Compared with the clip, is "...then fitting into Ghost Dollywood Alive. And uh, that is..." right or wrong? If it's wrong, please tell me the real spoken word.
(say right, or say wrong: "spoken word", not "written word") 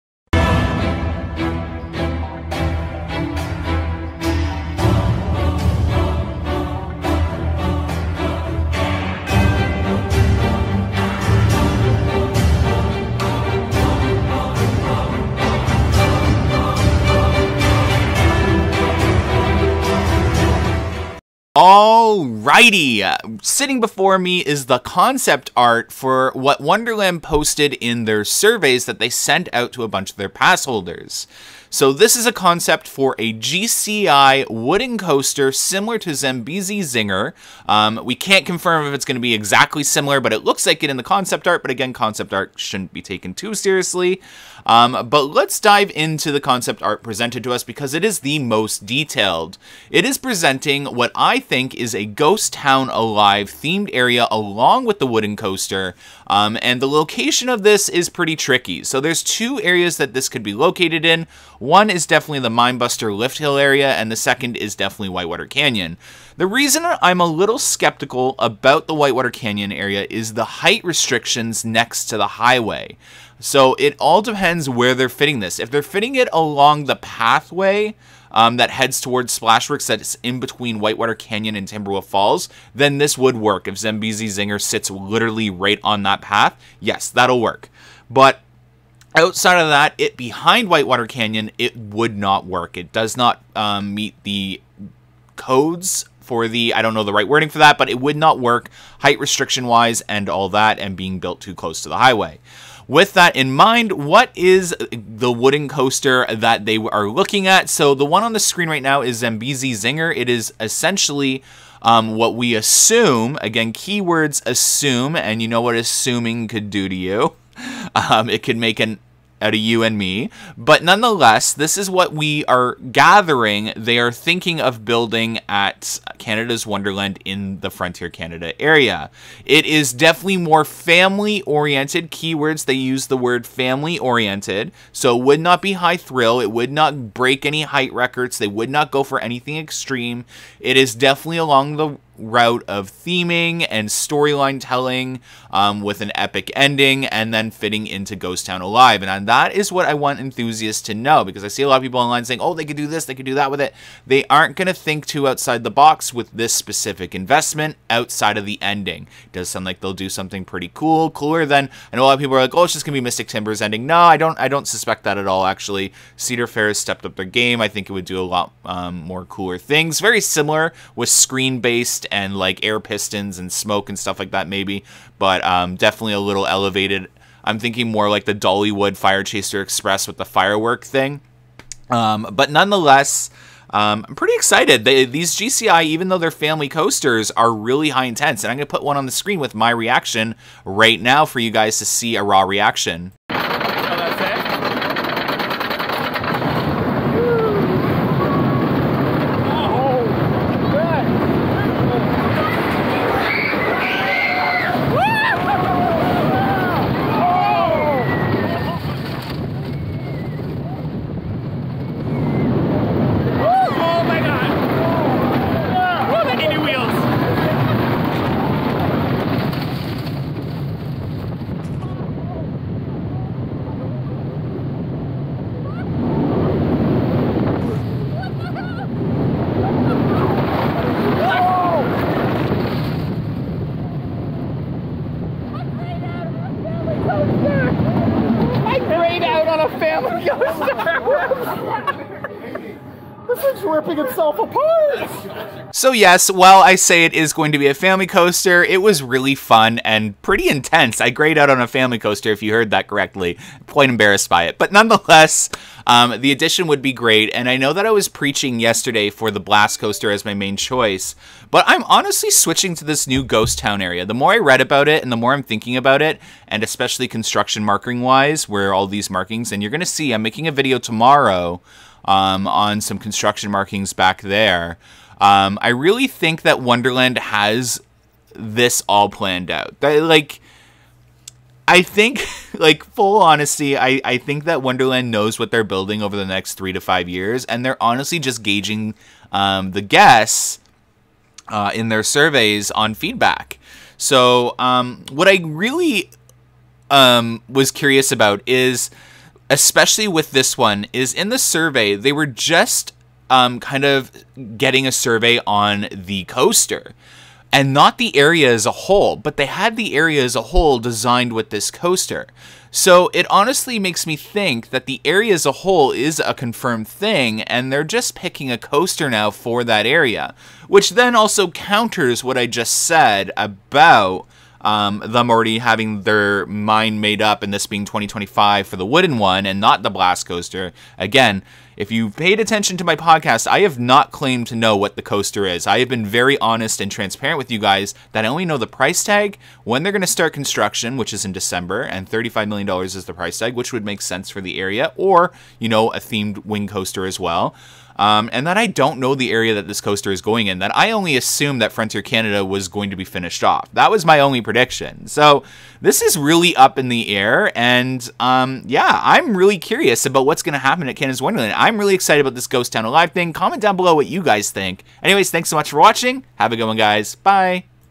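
wrong: "Town", not "Dollywood".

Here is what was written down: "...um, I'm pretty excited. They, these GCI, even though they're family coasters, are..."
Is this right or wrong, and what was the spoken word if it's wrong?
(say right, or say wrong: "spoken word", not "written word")
right.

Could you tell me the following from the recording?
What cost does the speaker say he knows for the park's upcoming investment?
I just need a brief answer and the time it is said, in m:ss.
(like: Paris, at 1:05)
$35 million, at 5:42.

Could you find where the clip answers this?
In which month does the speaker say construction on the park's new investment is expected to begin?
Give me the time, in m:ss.
5:41.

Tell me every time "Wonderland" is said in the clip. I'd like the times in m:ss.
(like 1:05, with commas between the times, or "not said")
0:26, 2:06, 4:36, 4:44, 6:01.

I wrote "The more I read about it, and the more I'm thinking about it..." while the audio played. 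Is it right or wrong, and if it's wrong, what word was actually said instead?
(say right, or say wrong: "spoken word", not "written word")
right.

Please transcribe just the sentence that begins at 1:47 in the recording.
So the one on the screen right now is Zambezi Zinger.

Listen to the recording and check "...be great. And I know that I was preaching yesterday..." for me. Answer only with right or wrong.
right.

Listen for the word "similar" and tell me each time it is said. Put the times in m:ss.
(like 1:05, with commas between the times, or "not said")
0:35, 0:39, 2:50.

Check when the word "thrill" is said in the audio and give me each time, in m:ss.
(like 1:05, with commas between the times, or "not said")
2:15.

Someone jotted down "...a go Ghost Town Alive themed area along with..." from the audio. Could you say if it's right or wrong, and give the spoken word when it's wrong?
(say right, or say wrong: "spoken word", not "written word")
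right.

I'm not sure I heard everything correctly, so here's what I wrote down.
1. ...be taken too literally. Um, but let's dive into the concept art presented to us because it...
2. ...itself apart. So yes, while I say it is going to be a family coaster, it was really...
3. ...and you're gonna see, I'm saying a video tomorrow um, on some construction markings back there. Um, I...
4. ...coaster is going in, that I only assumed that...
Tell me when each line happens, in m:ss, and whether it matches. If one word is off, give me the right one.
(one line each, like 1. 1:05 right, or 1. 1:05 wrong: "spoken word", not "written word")
1. 0:42 wrong: "seriously", not "literally"
2. 4:03 right
3. 4:29 wrong: "making", not "saying"
4. 5:49 right.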